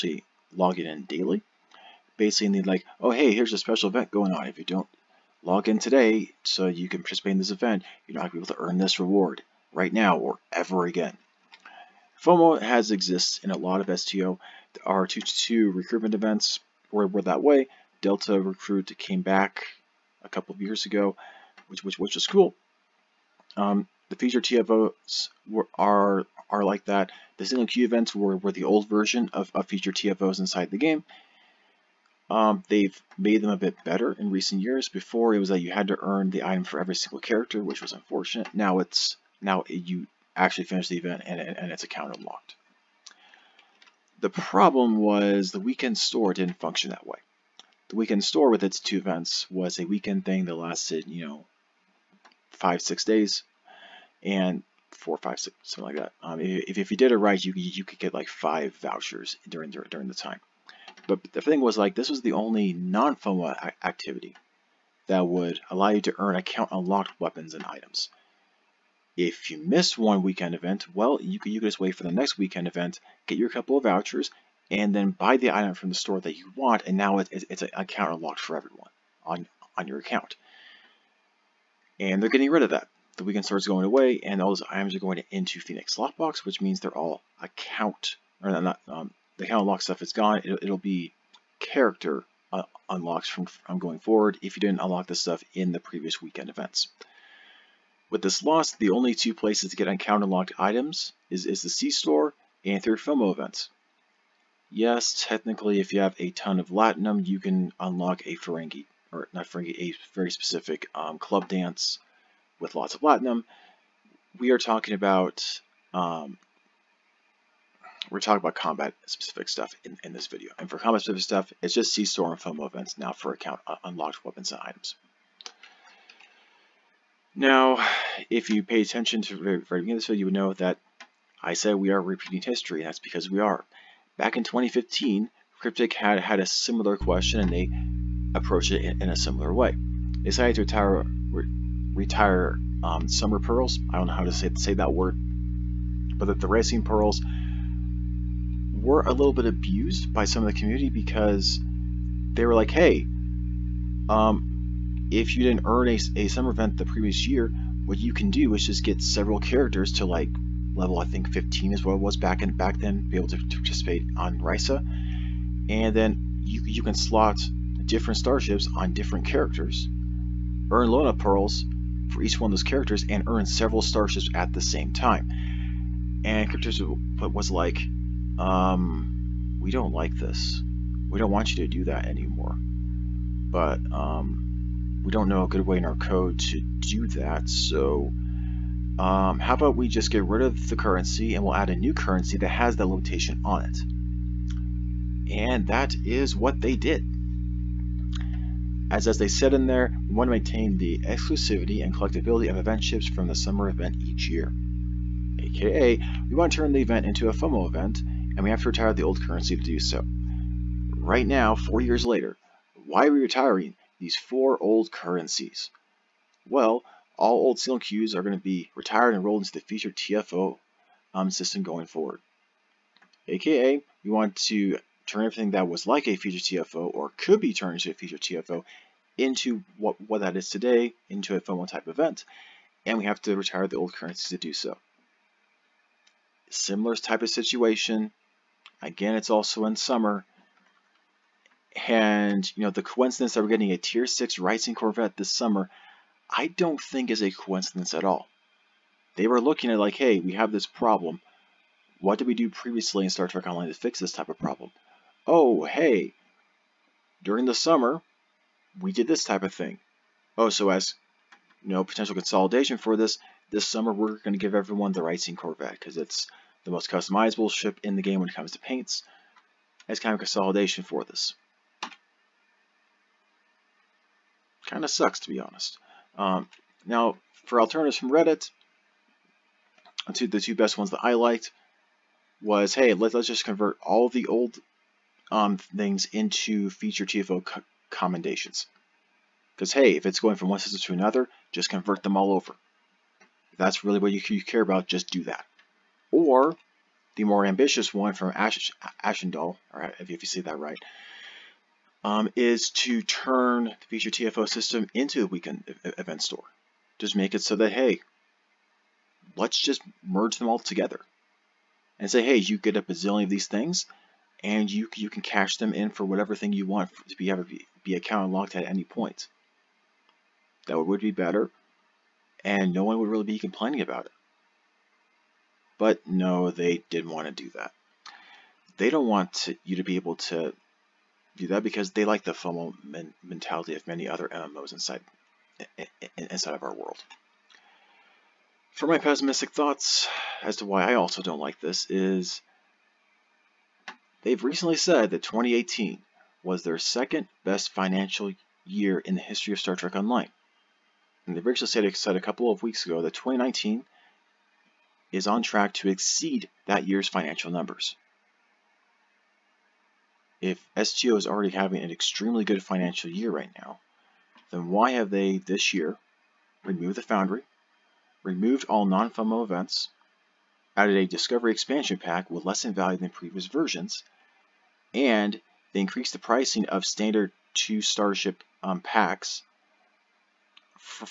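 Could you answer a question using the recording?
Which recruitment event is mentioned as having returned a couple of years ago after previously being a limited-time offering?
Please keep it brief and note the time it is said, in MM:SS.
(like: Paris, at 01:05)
Delta Recruit, at 00:18.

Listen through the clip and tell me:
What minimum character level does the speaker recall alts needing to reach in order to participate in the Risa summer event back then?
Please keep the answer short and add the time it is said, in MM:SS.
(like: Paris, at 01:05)
15, at 02:41.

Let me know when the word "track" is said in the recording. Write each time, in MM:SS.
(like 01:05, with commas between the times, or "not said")
05:55.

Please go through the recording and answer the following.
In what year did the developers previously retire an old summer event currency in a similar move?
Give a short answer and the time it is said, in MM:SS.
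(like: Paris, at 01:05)
2015, at 02:14.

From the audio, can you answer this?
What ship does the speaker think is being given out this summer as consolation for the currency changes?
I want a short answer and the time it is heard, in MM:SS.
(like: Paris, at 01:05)
Tier 6 Risian Corvette, at 04:03.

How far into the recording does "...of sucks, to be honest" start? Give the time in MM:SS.
04:34.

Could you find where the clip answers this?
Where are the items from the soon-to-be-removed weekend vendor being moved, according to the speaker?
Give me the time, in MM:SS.
01:25.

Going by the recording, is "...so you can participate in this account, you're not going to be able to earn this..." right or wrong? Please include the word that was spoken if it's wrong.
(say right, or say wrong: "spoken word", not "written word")
wrong: "event", not "account".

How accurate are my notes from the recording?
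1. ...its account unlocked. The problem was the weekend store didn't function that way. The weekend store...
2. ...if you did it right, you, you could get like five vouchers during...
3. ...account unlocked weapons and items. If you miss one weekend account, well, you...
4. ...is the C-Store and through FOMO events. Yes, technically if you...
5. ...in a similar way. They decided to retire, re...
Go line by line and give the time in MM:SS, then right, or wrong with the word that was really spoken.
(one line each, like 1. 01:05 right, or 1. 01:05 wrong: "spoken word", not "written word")
1. 00:41 right
2. 00:56 right
3. 01:06 wrong: "event", not "account"
4. 01:41 right
5. 02:19 right.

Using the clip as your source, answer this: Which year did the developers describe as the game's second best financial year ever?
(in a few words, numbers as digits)
2018.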